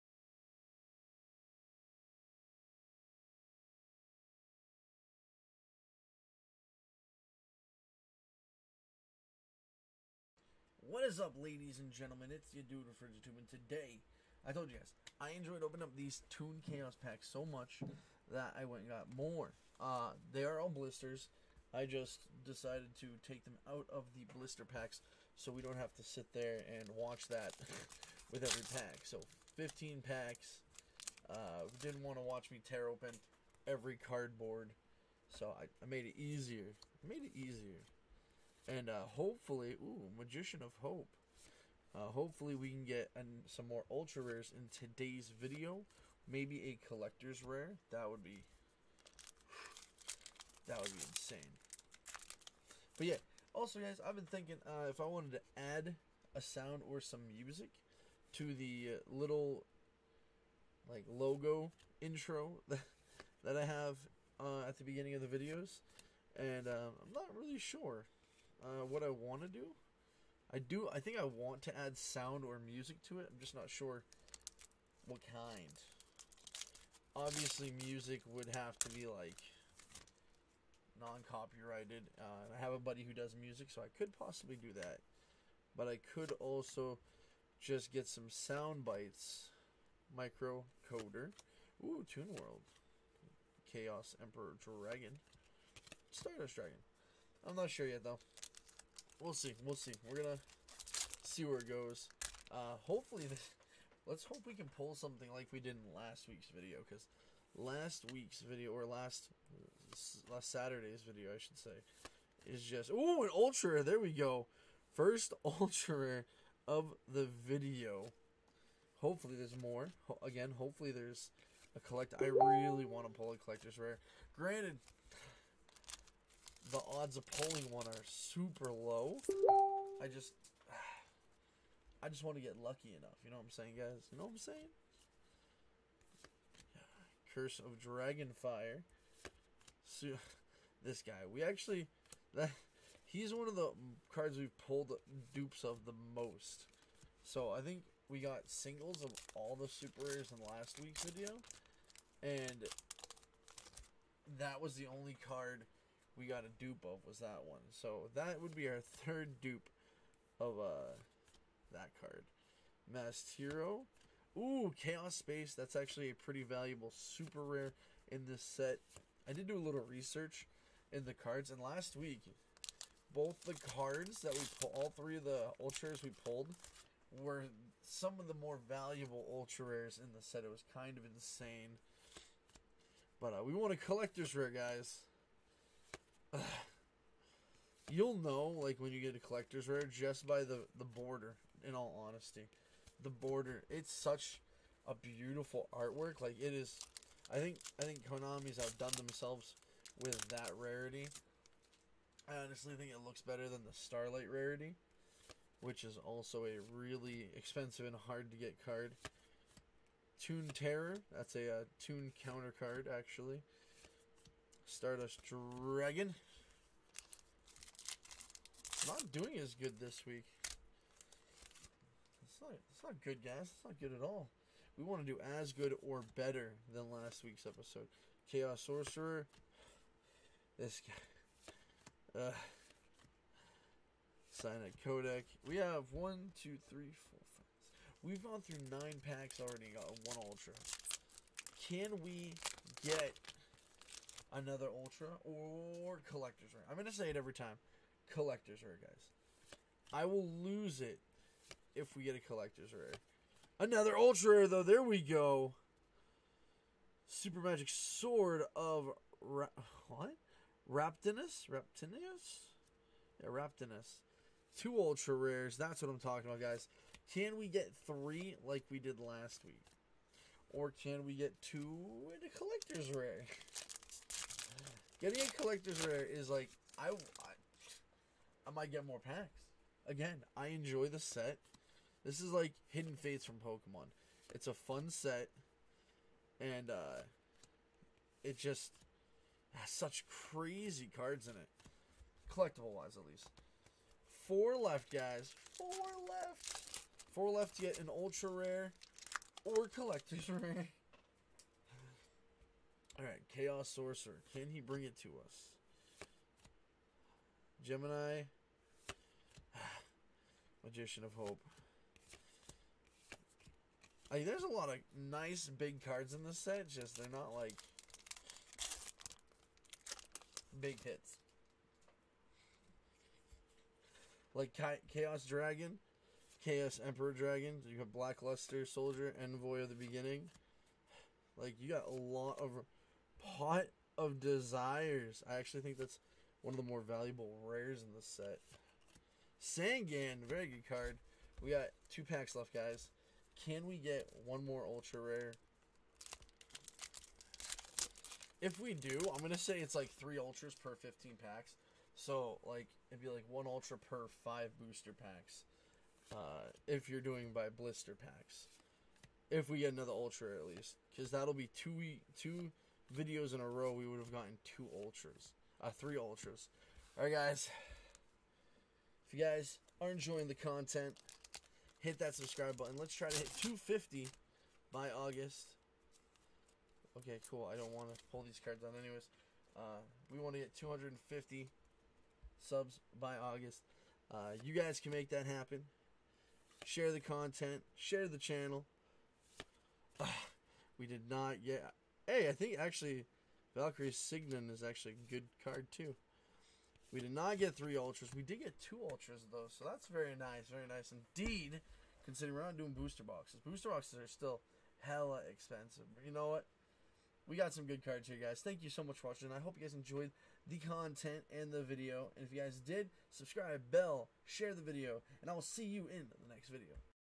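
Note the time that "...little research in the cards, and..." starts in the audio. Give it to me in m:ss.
2:49.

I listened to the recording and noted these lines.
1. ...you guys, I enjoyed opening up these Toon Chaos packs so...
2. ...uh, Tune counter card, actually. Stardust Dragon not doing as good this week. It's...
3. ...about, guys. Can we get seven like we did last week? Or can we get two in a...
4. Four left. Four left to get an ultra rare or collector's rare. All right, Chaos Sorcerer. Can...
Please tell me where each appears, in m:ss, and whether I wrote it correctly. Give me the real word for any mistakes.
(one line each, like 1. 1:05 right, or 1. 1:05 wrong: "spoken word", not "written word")
1. 0:14 right
2. 3:31 right
3. 4:26 wrong: "three", not "seven"
4. 4:55 right.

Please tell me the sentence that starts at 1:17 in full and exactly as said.
Obviously, music would have to be like non-copyrighted.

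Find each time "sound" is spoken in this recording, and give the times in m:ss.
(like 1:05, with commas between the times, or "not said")
0:56, 1:11, 1:28.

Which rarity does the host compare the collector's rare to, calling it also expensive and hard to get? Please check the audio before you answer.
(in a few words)
Starlight rarity.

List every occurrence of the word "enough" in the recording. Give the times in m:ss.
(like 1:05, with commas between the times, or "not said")
2:12.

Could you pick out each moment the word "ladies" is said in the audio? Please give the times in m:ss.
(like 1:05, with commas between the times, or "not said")
0:11.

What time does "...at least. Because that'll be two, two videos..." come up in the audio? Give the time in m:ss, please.
6:00.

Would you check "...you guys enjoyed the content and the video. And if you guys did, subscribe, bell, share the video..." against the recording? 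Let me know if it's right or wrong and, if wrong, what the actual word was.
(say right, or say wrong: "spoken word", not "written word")
right.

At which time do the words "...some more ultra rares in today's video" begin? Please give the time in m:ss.
0:43.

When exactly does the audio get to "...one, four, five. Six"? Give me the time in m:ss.
3:55.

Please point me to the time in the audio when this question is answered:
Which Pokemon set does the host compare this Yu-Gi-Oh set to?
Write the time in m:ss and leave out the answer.
4:42.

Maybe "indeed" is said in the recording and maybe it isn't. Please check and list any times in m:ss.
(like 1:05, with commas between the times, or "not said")
6:40.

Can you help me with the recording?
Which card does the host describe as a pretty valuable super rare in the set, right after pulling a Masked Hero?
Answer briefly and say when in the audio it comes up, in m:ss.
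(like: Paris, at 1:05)
Chaos Space, at 2:44.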